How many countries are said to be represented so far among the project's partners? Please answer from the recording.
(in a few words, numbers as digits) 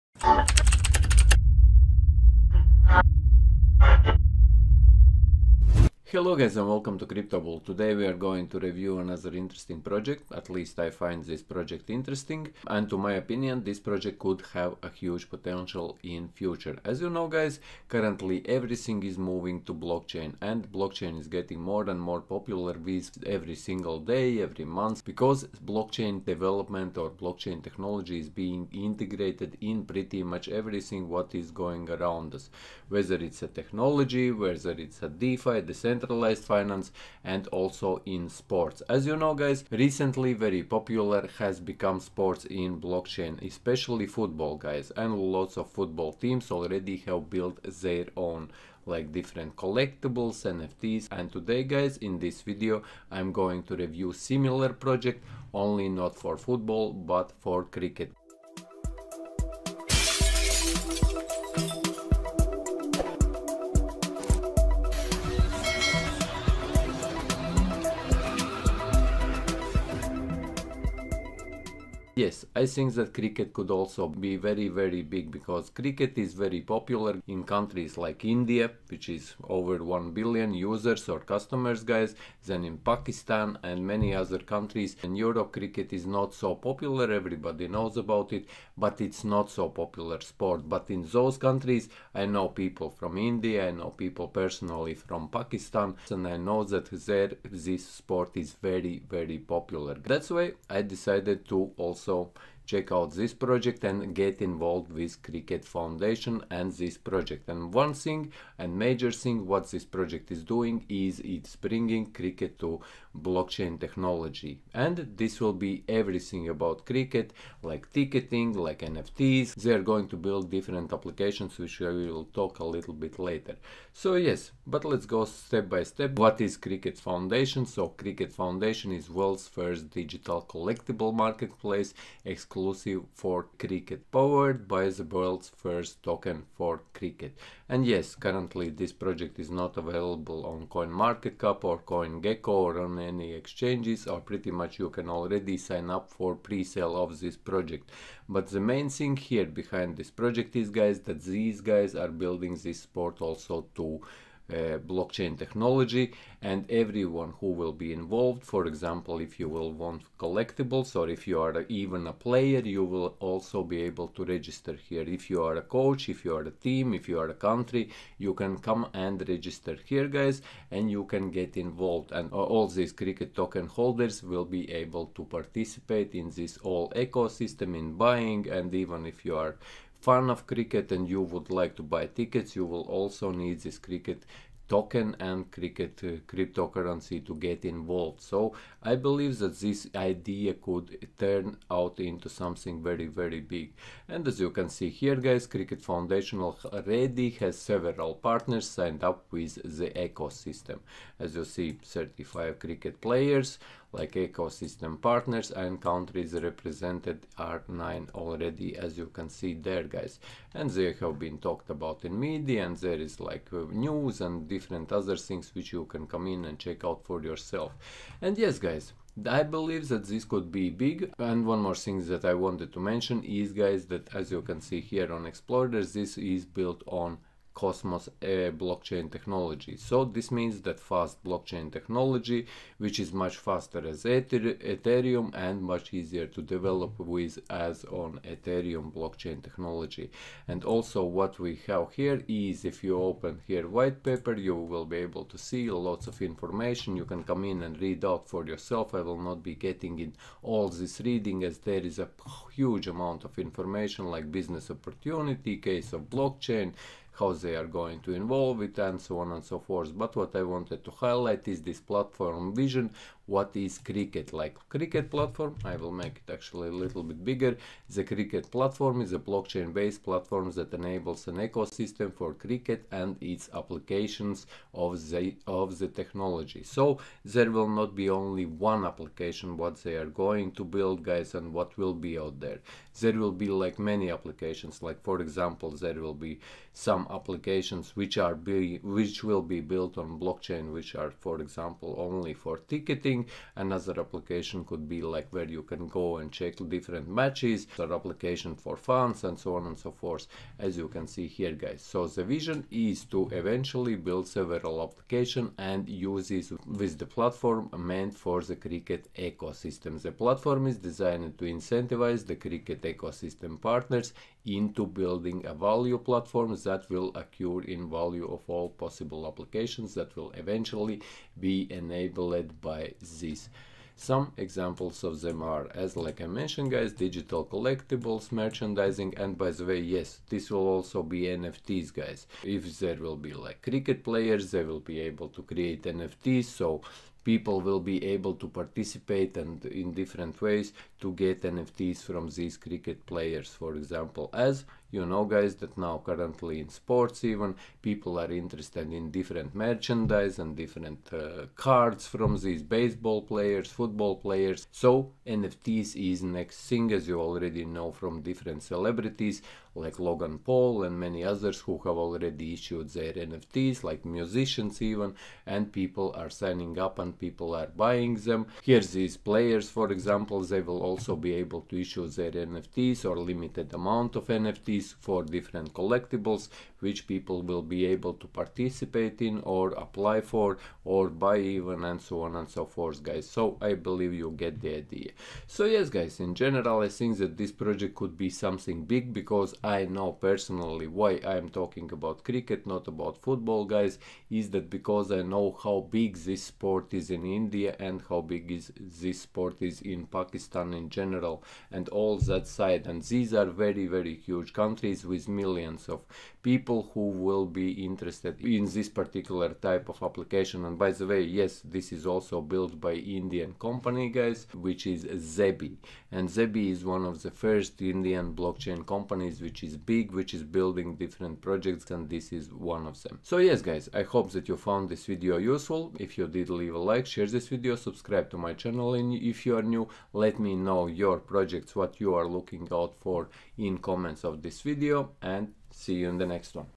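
9.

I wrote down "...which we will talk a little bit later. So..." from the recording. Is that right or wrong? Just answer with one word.
right.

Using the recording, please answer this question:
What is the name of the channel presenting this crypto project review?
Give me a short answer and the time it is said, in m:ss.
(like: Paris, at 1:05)
CryptoBull, at 0:07.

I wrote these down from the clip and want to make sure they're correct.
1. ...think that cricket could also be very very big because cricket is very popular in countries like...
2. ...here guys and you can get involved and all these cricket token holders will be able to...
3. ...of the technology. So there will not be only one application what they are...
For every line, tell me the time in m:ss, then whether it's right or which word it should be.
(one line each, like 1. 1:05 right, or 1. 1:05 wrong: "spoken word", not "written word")
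1. 1:12 right
2. 2:49 right
3. 4:35 right.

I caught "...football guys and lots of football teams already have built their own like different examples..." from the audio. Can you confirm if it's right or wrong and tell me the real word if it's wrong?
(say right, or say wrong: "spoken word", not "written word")
wrong: "collectibles", not "examples".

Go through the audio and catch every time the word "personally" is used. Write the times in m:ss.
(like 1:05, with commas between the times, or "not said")
1:34, 6:30.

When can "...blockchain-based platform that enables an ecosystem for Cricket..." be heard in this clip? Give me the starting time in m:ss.
4:29.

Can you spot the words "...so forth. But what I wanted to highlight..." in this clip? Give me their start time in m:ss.
4:19.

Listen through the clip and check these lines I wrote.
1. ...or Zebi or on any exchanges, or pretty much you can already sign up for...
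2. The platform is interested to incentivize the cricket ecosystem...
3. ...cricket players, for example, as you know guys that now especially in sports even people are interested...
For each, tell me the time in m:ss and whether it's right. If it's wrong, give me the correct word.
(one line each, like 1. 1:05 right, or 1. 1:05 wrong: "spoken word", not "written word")
1. 2:21 wrong: "CoinGecko", not "Zebi"
2. 5:10 wrong: "designed", not "interested"
3. 5:42 wrong: "currently", not "especially".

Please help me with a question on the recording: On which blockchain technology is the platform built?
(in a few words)
Cosmos.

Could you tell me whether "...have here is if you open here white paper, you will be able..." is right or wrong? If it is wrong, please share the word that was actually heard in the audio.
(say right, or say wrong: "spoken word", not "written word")
right.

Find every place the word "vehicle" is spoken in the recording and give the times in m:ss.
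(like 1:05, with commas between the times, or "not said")
not said.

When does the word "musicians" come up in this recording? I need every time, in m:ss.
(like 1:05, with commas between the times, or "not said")
6:04.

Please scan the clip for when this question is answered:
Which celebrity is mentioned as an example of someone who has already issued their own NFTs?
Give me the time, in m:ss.
5:59.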